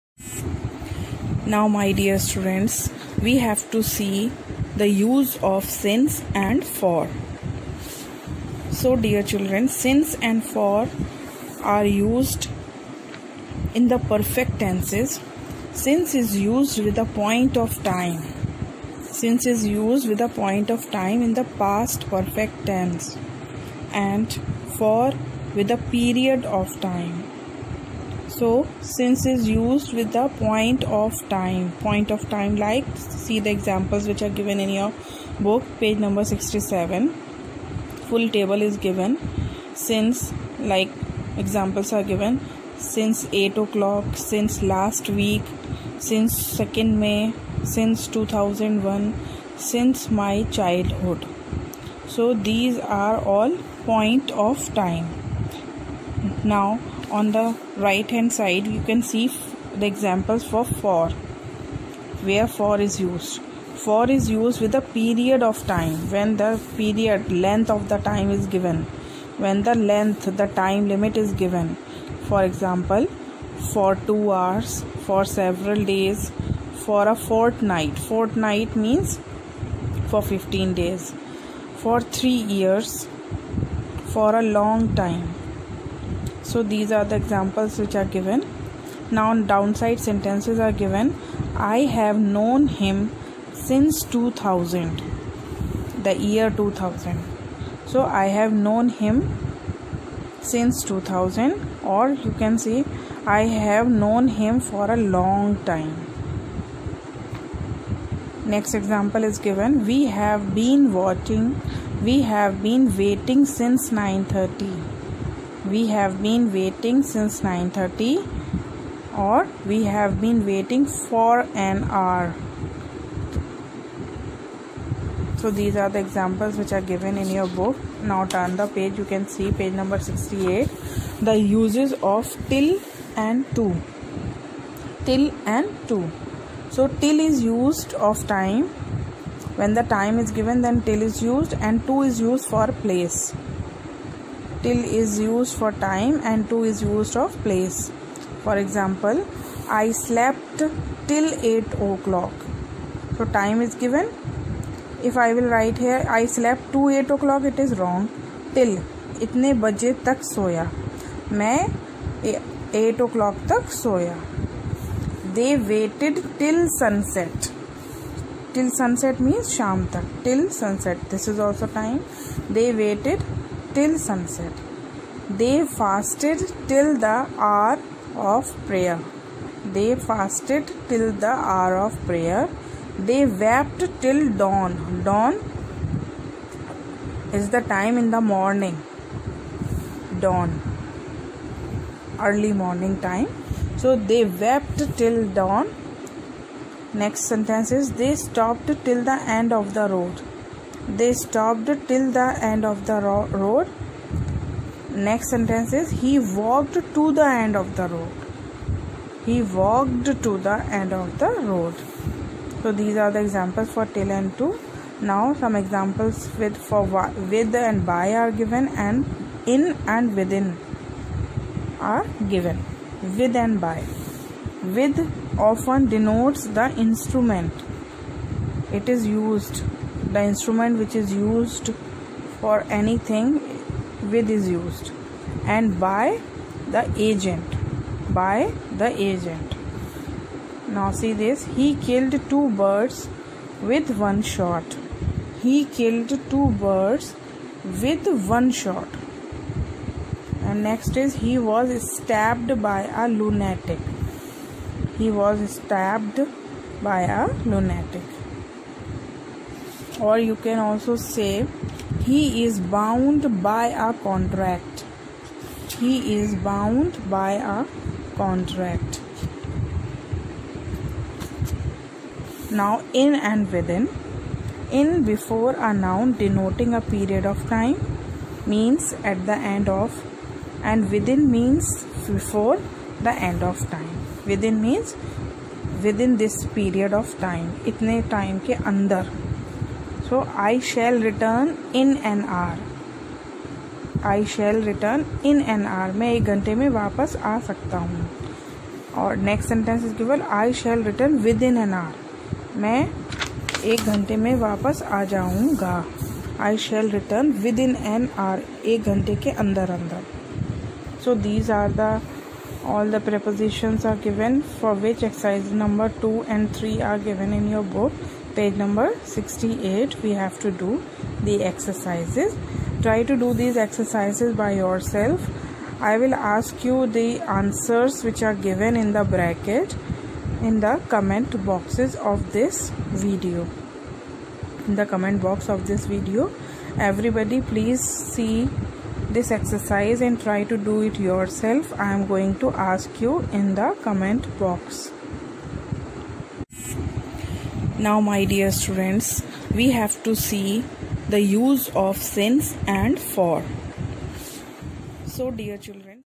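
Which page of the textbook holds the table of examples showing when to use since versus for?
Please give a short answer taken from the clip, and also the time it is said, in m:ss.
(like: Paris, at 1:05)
67, at 0:35.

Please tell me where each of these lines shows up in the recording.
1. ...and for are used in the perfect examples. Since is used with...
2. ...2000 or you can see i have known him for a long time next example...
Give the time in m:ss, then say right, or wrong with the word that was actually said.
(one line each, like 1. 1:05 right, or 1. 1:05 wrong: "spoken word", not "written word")
1. 0:10 wrong: "tenses", not "examples"
2. 1:40 right.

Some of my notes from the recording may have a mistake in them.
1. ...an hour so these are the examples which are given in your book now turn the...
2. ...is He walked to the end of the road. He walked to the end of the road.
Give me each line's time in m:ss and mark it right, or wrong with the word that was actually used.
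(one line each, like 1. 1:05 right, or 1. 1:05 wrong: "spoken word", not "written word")
1. 2:01 right
2. 3:25 right.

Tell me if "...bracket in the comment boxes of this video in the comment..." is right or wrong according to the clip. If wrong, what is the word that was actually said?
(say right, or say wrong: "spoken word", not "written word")
right.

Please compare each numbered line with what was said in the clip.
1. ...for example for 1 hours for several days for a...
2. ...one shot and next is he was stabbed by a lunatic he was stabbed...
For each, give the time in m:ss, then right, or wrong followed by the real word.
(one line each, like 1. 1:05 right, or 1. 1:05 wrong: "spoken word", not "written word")
1. 1:12 wrong: "2", not "1"
2. 4:08 right.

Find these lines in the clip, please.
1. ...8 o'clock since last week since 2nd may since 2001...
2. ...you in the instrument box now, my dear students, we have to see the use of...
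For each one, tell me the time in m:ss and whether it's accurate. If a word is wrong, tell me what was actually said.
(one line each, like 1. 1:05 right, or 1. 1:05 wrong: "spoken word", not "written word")
1. 0:43 right
2. 5:43 wrong: "comment", not "instrument".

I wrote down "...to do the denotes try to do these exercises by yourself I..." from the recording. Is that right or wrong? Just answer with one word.
wrong.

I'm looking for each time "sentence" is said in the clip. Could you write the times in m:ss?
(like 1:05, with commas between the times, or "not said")
1:30, 3:17, 3:25.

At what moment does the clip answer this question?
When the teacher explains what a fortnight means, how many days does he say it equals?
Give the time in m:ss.
1:20.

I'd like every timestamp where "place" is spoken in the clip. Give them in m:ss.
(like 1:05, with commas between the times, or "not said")
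2:22, 2:27.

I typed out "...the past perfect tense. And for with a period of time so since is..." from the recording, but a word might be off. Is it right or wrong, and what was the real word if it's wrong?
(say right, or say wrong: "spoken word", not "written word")
right.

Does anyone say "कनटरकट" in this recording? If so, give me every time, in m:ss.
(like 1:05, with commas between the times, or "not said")
4:24, 4:28.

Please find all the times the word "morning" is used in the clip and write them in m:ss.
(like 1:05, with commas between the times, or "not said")
3:08, 3:12.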